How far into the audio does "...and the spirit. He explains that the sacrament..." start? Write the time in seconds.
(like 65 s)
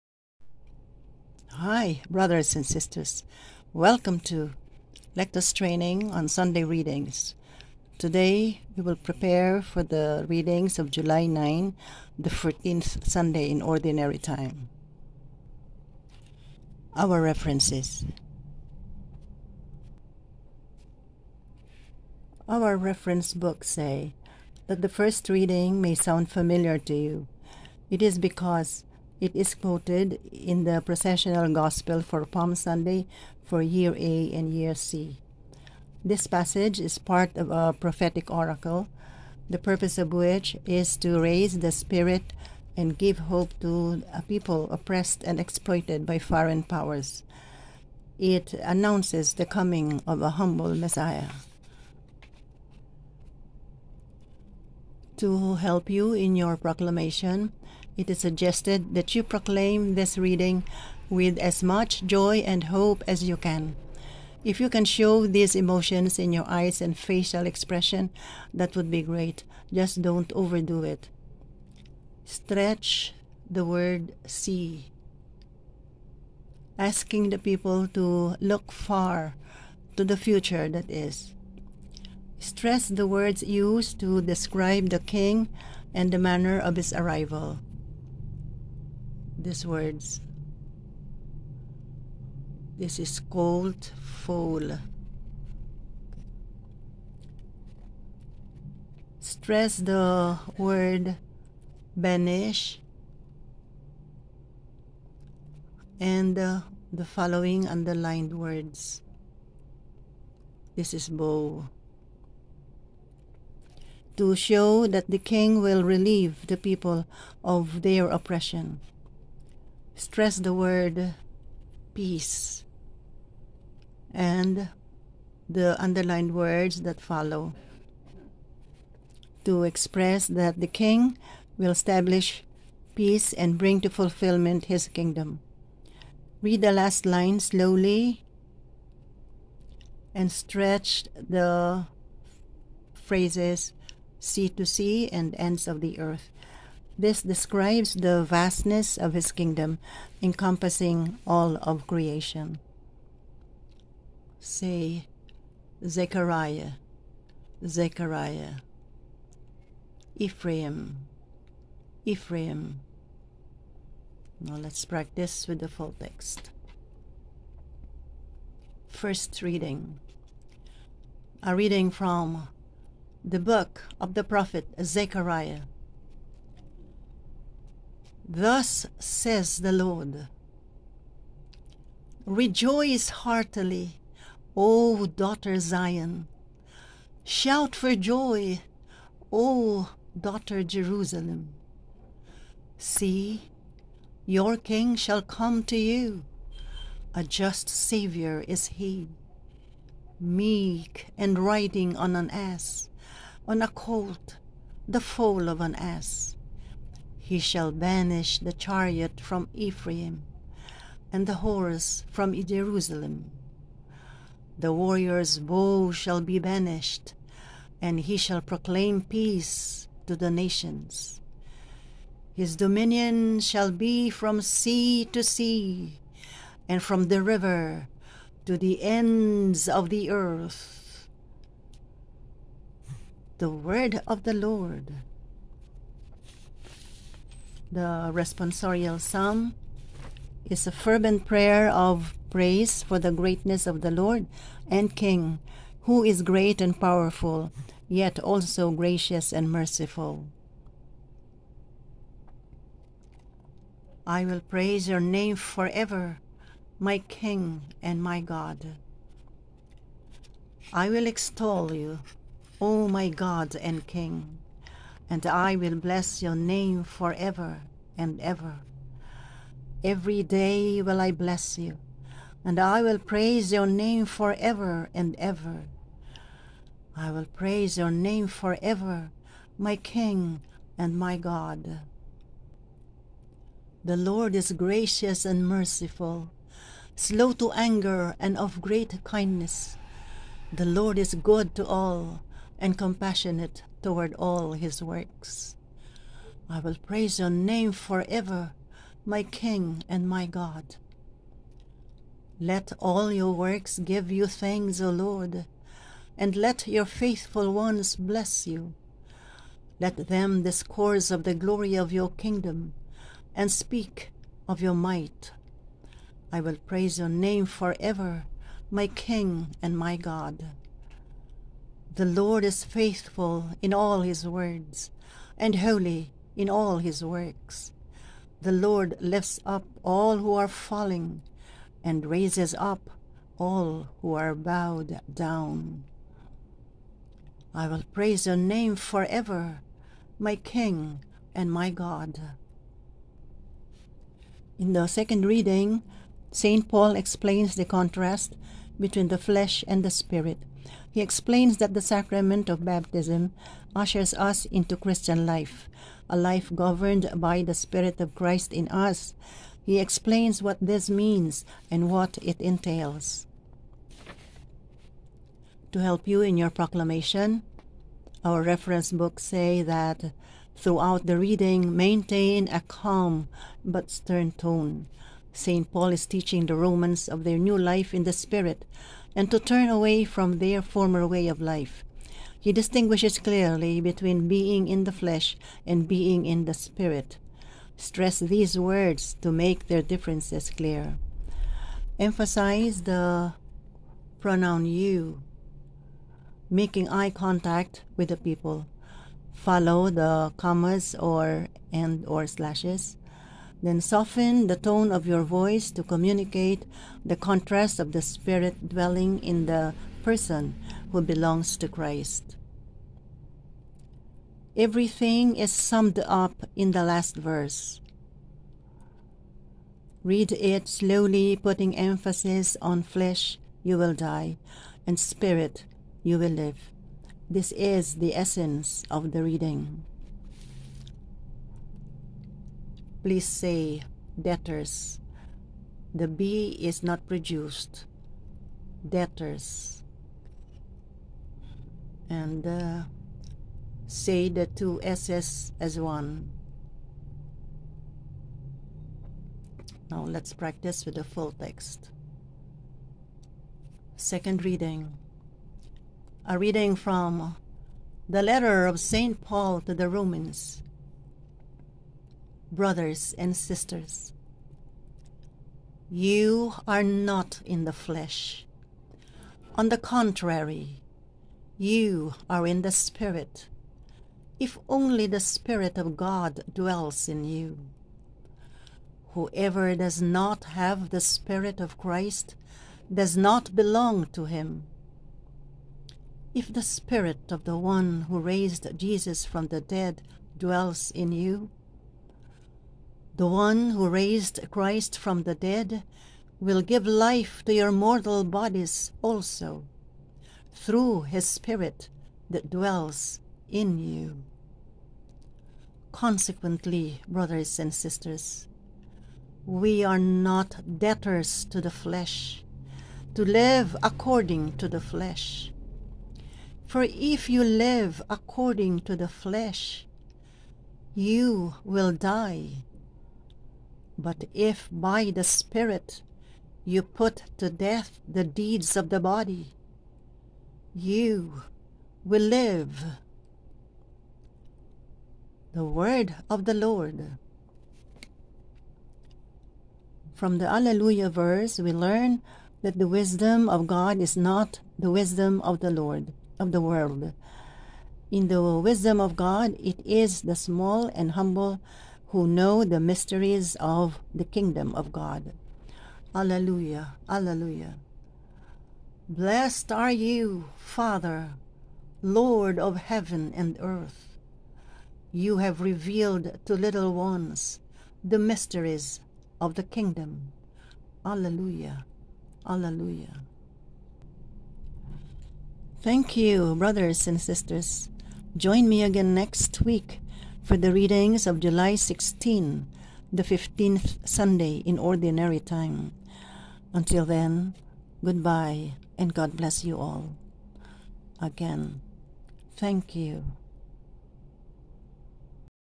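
349 s.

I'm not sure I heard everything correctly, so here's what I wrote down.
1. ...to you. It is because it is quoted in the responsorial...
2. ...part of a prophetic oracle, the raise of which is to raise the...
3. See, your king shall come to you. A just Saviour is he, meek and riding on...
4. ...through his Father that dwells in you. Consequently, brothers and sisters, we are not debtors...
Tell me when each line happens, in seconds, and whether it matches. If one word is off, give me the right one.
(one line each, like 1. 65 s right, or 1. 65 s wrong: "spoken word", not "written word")
1. 26 s wrong: "processional", not "responsorial"
2. 36 s wrong: "purpose", not "raise"
3. 192 s right
4. 500 s wrong: "Spirit", not "Father".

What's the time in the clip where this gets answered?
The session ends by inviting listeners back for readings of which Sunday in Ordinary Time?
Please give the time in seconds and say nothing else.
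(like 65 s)
583 s.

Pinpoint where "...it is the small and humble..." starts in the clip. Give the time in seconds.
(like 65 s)
549 s.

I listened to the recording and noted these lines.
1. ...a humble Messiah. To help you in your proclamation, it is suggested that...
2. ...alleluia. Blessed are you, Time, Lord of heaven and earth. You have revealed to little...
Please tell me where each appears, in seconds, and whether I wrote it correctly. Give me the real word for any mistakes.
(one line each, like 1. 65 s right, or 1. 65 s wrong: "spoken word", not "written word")
1. 50 s right
2. 557 s wrong: "Father", not "Time".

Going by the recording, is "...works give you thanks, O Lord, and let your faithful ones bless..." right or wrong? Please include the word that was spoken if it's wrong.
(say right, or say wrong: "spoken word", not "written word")
right.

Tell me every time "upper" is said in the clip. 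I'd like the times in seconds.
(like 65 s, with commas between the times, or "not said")
not said.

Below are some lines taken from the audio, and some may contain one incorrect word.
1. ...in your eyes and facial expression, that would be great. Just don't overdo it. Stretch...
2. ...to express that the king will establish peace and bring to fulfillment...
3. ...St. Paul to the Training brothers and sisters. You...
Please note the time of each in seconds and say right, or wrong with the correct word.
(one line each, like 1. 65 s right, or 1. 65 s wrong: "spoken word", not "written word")
1. 66 s right
2. 129 s right
3. 458 s wrong: "Romans", not "Training".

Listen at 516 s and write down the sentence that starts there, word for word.
For if you live according to the flesh, you will die.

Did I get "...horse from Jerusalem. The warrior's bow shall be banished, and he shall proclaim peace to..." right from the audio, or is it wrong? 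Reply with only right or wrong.
right.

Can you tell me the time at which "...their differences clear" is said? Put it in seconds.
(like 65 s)
389 s.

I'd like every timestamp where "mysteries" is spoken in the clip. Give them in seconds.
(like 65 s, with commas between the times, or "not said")
552 s, 568 s.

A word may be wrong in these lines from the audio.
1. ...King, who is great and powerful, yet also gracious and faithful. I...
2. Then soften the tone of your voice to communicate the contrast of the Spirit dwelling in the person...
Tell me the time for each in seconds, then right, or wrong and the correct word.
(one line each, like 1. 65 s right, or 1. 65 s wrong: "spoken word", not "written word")
1. 244 s wrong: "merciful", not "faithful"
2. 403 s right.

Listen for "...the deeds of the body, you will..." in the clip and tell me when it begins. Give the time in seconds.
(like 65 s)
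528 s.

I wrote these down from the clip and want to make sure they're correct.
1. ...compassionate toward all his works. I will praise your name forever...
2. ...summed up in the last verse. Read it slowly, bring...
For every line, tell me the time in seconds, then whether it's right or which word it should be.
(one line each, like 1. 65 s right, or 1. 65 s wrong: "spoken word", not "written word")
1. 292 s right
2. 415 s wrong: "putting", not "bring".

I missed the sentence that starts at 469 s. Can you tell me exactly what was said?
On the contrary, you are in the Spirit, if only the Spirit of God dwells in you.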